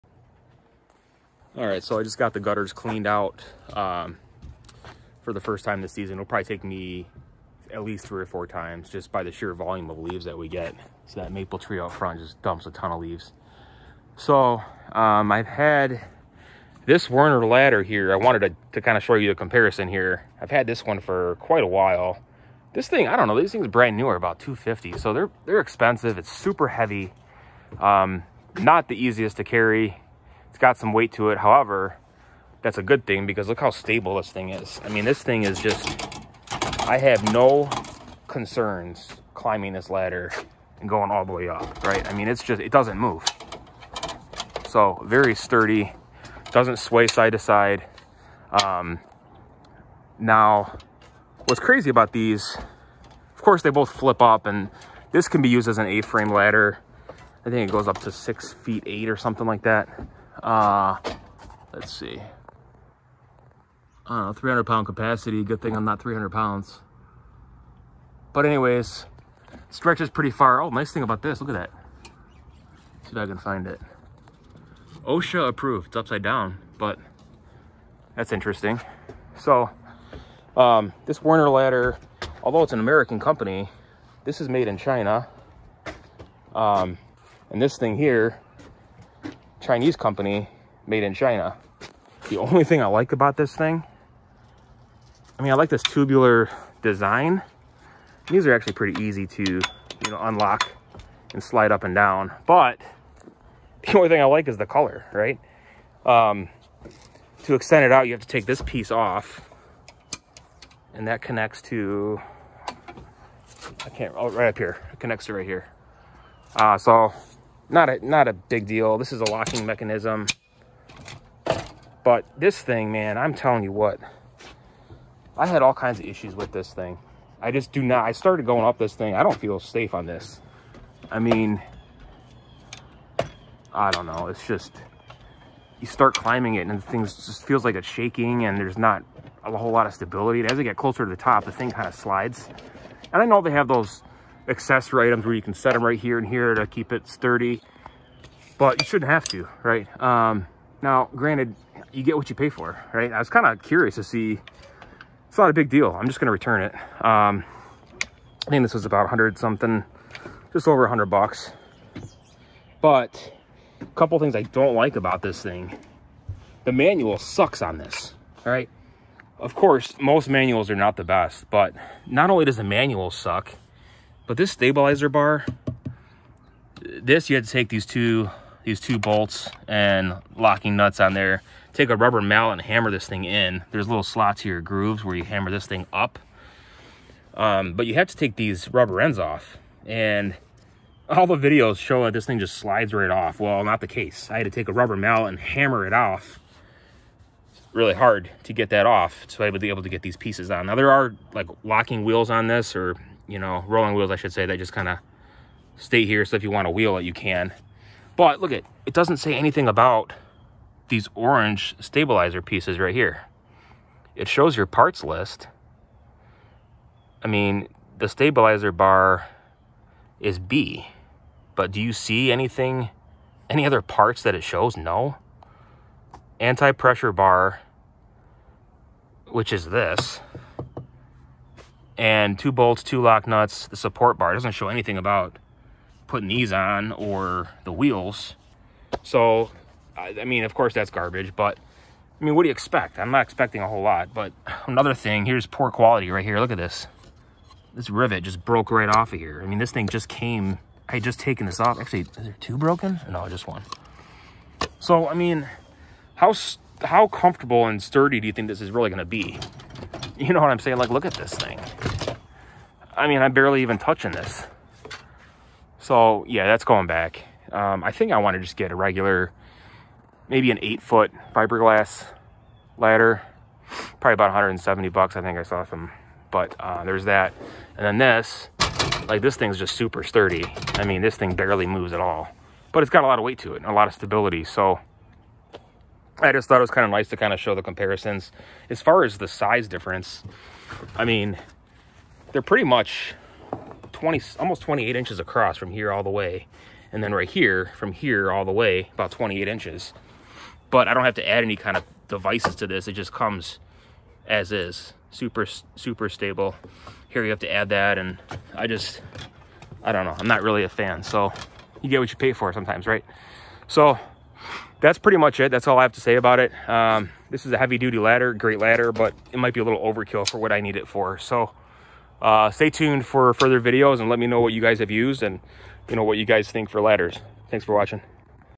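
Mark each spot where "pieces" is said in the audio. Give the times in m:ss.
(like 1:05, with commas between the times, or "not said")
1:48, 3:20, 3:32.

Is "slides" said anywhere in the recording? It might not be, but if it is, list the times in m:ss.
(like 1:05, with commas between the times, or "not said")
1:41, 2:21, 3:12.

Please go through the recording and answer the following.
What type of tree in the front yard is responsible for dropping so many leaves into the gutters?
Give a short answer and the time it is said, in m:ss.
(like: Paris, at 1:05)
maple, at 0:11.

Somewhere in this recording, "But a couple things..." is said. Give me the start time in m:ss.
2:42.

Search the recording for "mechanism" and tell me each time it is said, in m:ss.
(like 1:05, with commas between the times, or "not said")
1:59.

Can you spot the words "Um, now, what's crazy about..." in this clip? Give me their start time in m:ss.
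0:48.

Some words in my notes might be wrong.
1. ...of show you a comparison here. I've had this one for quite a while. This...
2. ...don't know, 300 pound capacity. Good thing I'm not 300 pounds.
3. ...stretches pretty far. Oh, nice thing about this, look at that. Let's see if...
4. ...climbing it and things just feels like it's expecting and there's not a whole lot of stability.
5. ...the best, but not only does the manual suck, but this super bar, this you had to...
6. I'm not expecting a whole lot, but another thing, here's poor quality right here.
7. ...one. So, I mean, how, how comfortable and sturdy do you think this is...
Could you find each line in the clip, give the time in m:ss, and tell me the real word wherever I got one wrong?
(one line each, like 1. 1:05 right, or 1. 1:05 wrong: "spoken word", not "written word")
1. 0:18 right
2. 1:04 right
3. 1:09 right
4. 2:16 wrong: "shaking", not "expecting"
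5. 2:50 wrong: "stabilizer", not "super"
6. 4:02 right
7. 4:13 right.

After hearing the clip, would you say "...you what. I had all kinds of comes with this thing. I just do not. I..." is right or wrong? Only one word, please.
wrong.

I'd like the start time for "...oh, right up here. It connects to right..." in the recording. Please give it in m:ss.
1:54.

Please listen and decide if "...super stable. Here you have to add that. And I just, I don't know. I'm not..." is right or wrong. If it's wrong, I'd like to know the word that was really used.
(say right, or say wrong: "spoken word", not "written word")
right.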